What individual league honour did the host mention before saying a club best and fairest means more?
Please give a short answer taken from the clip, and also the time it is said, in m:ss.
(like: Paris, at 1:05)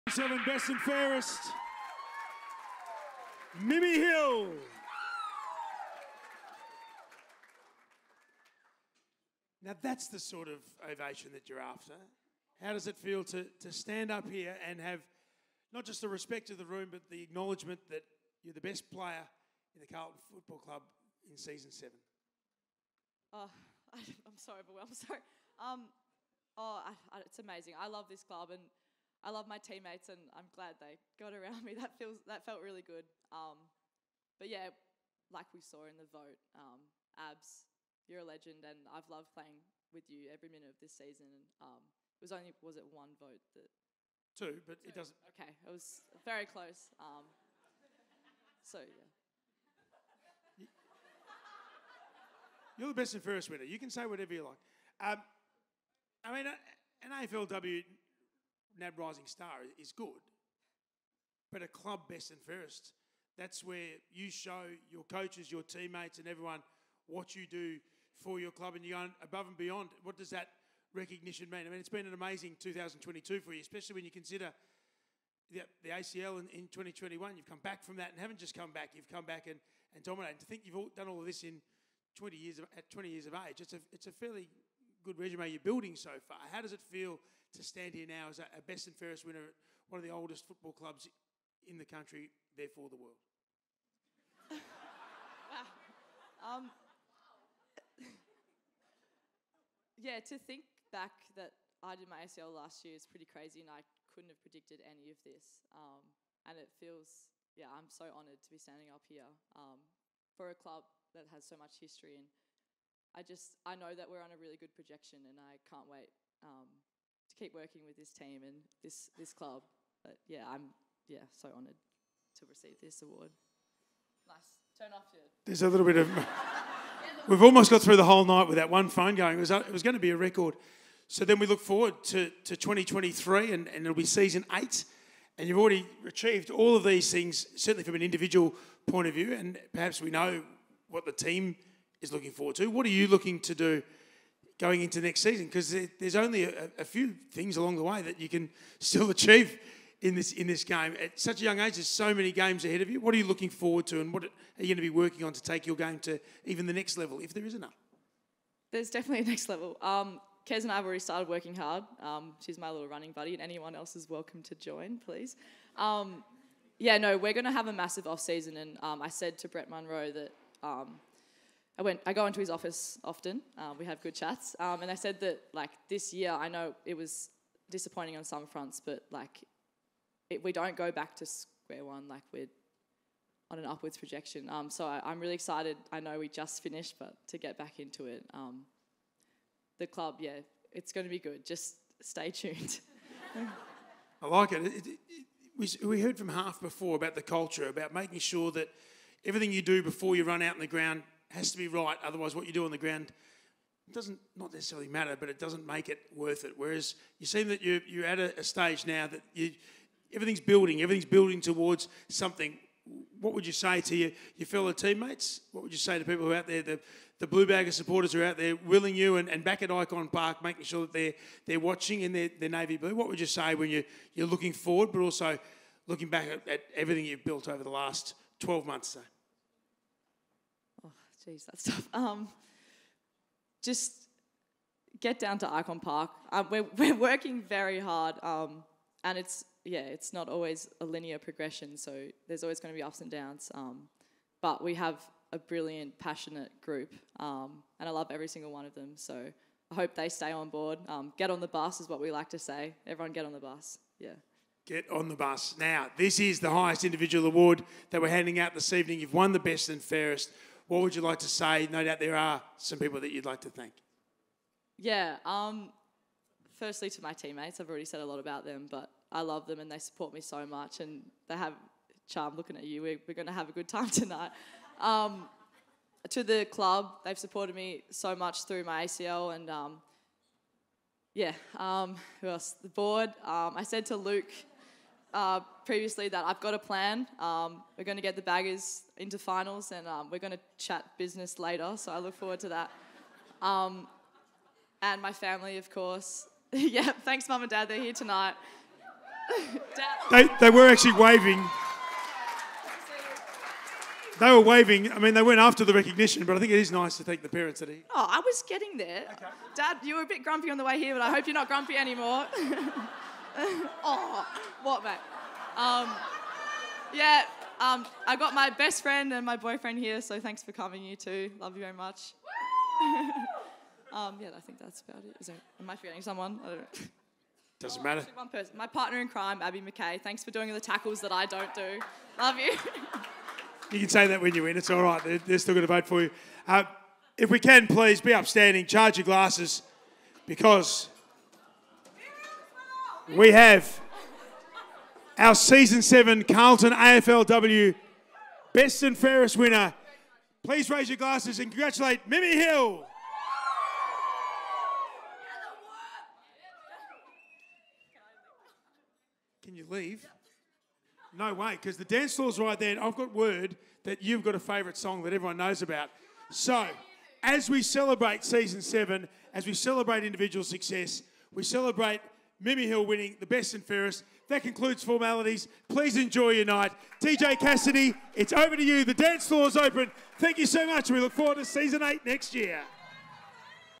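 AFLW NAB Rising Star, at 0:57.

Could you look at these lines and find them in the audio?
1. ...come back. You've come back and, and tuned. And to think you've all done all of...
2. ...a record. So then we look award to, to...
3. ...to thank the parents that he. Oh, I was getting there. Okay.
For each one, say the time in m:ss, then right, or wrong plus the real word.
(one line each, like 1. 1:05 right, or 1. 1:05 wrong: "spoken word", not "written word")
1. 1:18 wrong: "dominated", not "tuned"
2. 2:10 wrong: "forward", not "award"
3. 5:06 right.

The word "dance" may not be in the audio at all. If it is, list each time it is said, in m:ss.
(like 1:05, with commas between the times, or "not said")
6:01, 6:18.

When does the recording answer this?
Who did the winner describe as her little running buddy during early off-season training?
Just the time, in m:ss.
2:40.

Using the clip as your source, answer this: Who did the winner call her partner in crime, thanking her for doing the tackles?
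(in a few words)
Abbie McKay.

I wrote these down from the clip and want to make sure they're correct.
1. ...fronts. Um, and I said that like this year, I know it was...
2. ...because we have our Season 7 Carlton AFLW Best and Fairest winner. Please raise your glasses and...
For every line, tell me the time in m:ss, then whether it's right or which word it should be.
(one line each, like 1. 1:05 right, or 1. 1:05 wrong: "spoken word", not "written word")
1. 2:54 wrong: "chats", not "fronts"
2. 5:40 right.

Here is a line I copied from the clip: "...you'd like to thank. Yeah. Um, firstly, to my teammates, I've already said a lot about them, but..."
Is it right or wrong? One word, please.
right.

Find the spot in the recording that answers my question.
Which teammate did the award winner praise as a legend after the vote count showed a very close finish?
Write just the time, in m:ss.
0:37.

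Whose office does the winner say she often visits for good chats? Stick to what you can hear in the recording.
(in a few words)
Brett Munro.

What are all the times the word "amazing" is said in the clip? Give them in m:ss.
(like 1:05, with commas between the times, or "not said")
0:27, 1:12.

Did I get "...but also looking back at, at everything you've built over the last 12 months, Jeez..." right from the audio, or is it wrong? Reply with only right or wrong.
right.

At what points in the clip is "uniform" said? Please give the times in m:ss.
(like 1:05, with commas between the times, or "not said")
not said.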